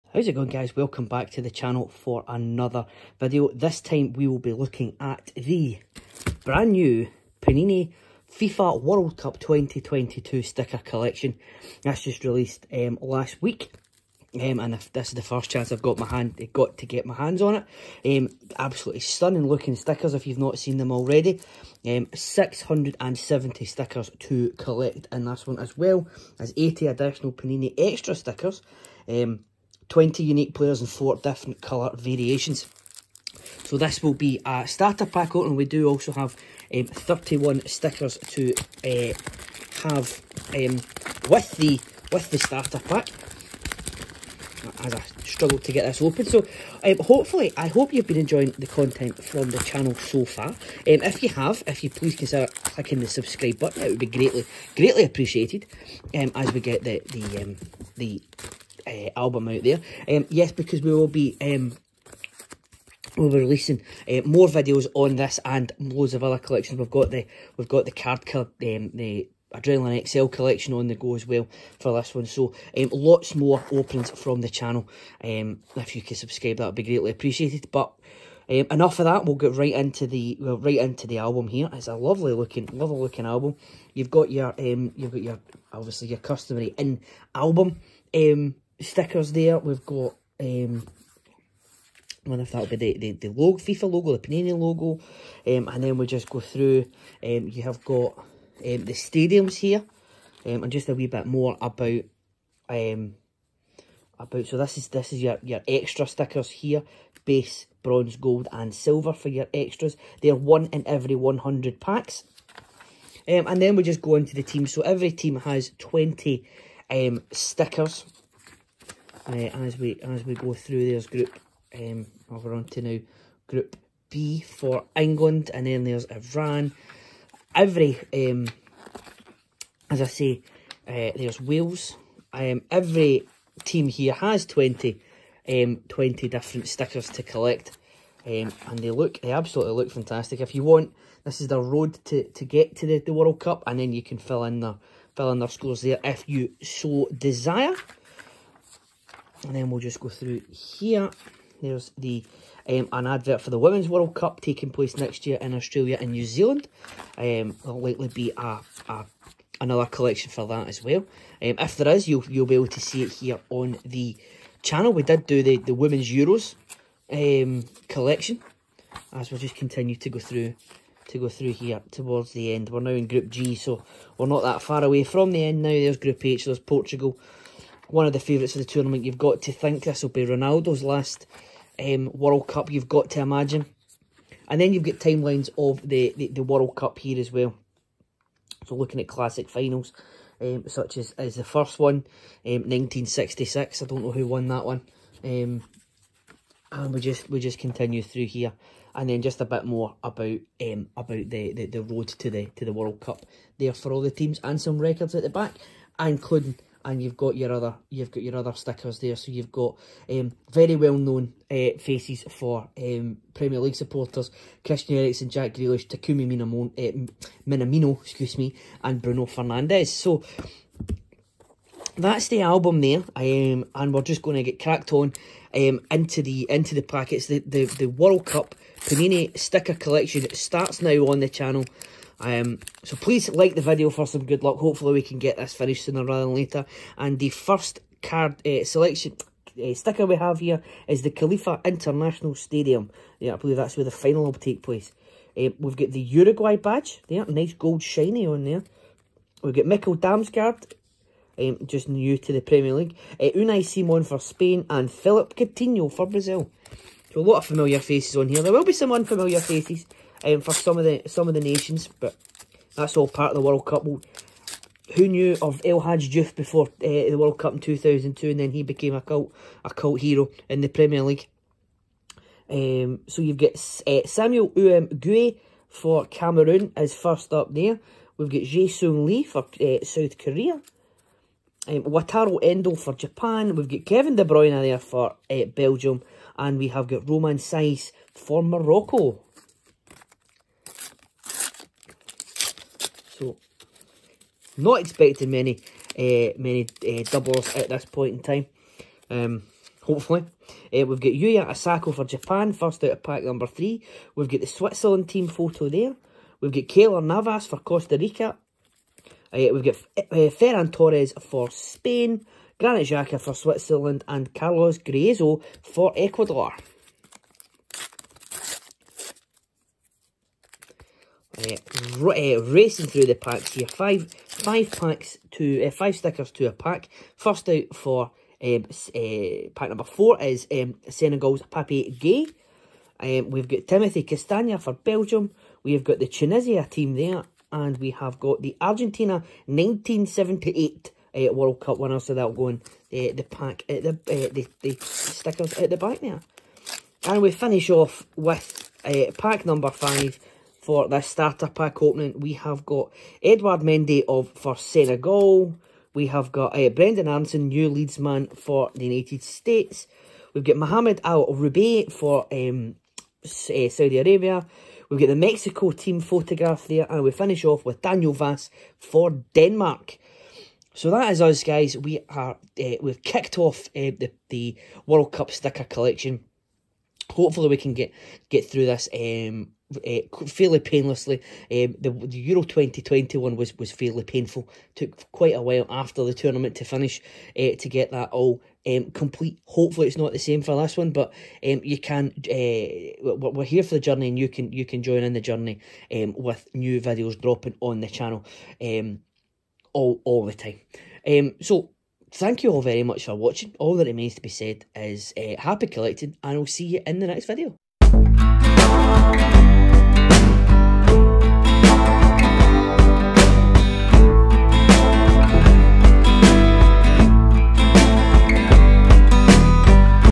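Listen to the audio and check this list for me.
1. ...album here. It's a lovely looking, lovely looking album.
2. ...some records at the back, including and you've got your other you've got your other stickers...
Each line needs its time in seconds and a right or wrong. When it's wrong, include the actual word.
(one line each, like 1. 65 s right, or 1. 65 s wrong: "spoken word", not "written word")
1. 81 s right
2. 204 s right.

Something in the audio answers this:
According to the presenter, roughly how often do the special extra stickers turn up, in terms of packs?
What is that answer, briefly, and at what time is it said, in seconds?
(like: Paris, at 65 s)
One in every 100 packs, at 110 s.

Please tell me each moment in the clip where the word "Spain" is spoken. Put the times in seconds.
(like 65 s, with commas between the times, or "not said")
254 s, 311 s.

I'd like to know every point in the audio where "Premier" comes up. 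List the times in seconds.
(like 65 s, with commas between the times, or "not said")
213 s, 252 s, 270 s.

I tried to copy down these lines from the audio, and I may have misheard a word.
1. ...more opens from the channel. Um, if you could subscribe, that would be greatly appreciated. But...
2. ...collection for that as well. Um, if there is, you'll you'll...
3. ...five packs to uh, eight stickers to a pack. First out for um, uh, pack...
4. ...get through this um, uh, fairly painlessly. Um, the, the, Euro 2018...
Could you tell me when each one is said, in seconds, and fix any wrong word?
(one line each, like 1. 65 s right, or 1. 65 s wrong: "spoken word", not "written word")
1. 73 s right
2. 159 s right
3. 324 s wrong: "five", not "eight"
4. 378 s wrong: "2021", not "2018".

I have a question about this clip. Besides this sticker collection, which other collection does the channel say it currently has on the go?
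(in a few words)
Adrenaline XL.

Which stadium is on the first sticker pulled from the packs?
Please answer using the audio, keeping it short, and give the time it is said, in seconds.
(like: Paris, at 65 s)
Khalifa International Stadium, at 241 s.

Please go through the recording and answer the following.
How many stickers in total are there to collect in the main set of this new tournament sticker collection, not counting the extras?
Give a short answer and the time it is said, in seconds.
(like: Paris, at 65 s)
670, at 22 s.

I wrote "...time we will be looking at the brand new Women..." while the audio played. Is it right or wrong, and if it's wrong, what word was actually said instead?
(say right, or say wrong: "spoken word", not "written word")
wrong: "Panini", not "Women".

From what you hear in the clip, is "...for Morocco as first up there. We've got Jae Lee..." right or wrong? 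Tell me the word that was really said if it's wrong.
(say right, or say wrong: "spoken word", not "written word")
wrong: "Cameroon", not "Morocco".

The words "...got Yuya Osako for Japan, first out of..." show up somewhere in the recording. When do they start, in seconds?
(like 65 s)
300 s.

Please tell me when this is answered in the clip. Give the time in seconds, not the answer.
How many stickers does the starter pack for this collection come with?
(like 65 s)
36 s.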